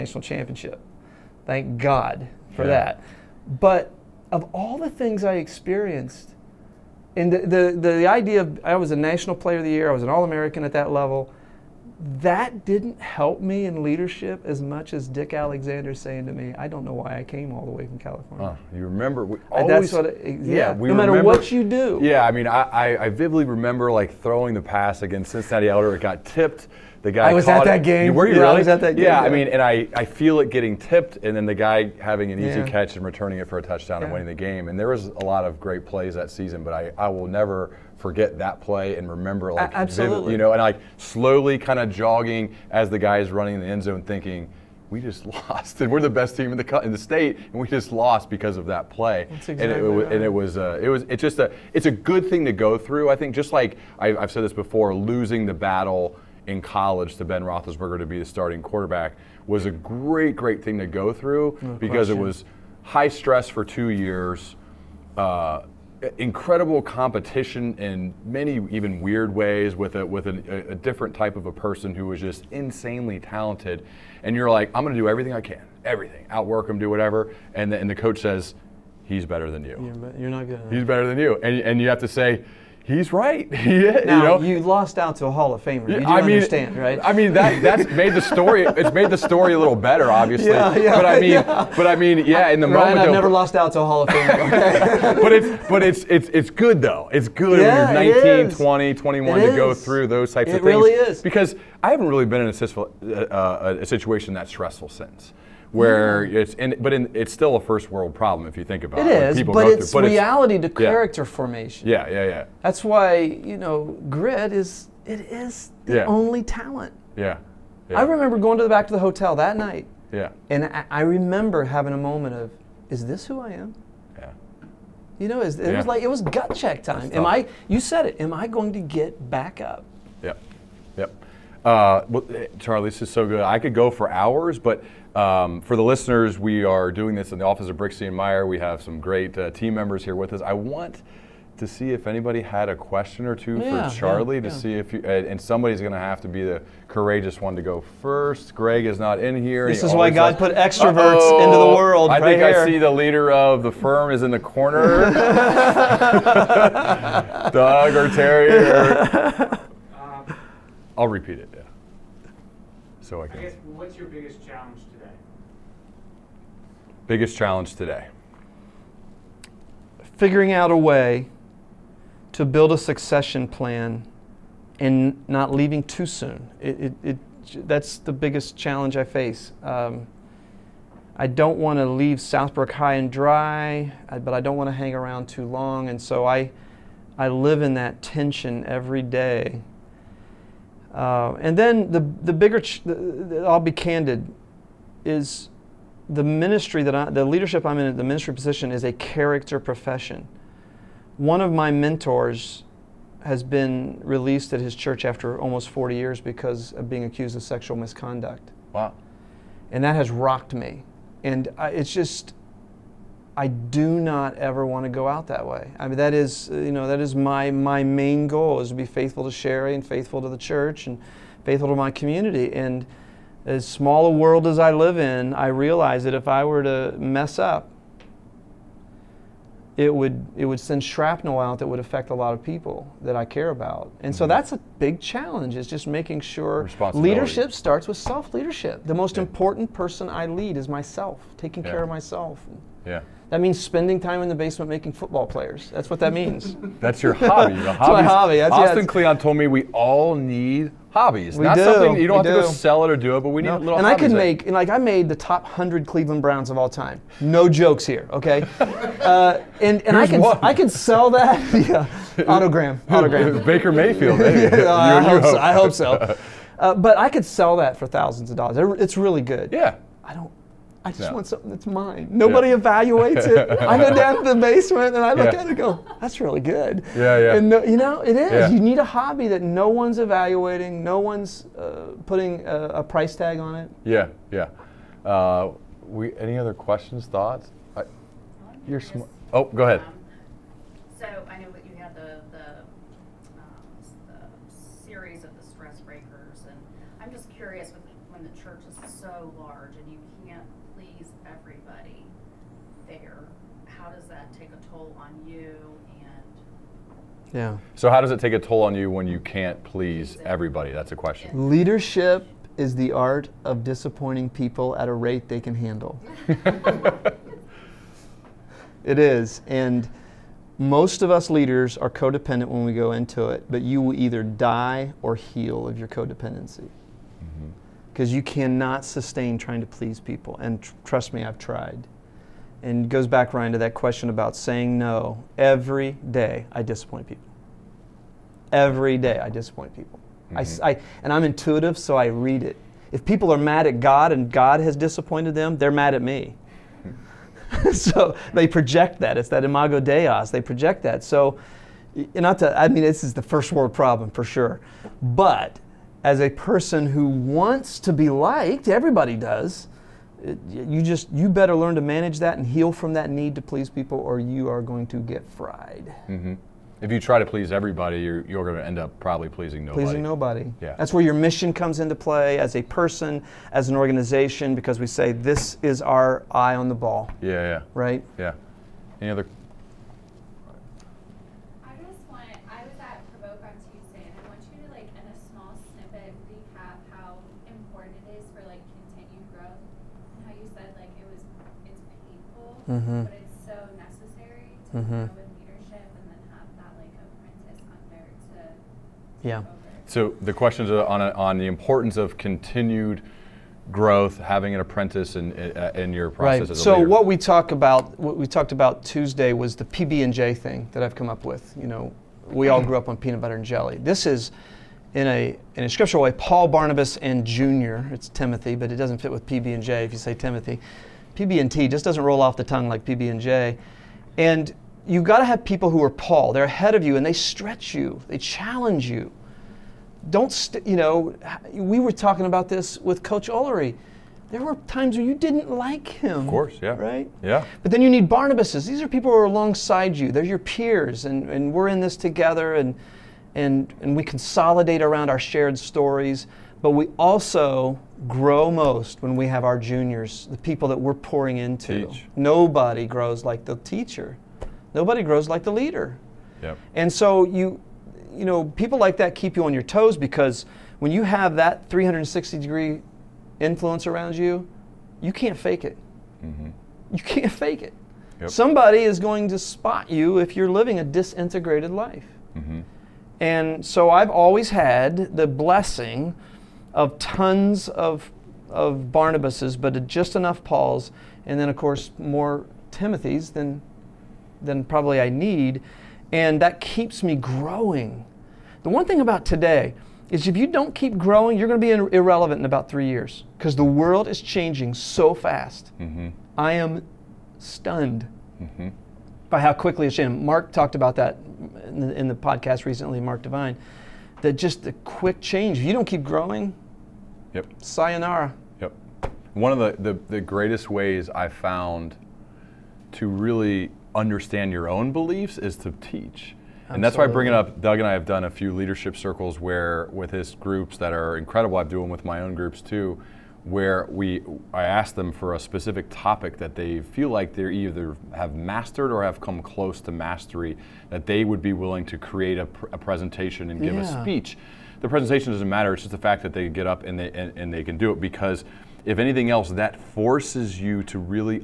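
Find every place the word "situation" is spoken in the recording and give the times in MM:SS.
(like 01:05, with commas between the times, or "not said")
01:43.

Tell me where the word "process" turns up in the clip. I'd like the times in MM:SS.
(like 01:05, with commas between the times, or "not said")
06:46.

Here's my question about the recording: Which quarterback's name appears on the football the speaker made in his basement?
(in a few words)
Baker Mayfield.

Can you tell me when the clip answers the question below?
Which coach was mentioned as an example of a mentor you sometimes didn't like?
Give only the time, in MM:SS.
07:13.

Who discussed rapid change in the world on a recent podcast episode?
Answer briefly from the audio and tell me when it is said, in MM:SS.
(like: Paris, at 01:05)
Mark Divine, at 08:23.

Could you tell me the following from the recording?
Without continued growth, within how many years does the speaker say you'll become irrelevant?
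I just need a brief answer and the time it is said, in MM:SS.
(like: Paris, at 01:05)
3 years, at 08:12.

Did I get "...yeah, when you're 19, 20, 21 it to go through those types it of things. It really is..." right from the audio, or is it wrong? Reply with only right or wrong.
right.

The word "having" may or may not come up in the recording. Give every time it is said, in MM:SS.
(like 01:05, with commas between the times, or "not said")
00:31, 02:01, 06:44.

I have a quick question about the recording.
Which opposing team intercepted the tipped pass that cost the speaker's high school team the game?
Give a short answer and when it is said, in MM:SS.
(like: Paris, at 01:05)
Cincinnati Elder, at 00:25.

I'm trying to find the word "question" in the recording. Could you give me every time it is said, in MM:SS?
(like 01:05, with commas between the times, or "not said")
01:02, 02:22, 04:46, 05:10, 05:33, 06:40.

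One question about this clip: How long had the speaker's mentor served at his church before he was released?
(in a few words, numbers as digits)
almost 40 years.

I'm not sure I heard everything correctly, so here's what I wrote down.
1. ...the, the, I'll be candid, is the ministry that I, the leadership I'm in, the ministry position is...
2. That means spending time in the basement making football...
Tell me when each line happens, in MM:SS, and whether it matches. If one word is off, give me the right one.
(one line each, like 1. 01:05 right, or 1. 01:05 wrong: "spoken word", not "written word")
1. 03:12 right
2. 04:03 right.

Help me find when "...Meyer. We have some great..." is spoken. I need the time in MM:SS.
02:18.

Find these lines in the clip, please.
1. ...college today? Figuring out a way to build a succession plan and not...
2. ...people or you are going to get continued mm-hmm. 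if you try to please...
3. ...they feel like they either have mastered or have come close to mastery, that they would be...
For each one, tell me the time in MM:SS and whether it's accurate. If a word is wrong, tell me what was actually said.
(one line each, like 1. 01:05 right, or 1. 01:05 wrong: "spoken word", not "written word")
1. 02:47 wrong: "challenge", not "college"
2. 06:03 wrong: "fried", not "continued"
3. 08:46 right.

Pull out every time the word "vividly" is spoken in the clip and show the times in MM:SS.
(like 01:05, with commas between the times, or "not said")
00:23.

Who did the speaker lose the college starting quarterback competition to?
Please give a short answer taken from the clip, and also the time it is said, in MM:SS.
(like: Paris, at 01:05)
Ben Roethlisberger, at 00:57.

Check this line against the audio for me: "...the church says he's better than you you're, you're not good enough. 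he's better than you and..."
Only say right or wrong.
wrong.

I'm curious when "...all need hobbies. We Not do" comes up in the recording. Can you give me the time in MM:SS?
04:09.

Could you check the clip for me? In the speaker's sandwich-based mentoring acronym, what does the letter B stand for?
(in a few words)
Barnabas.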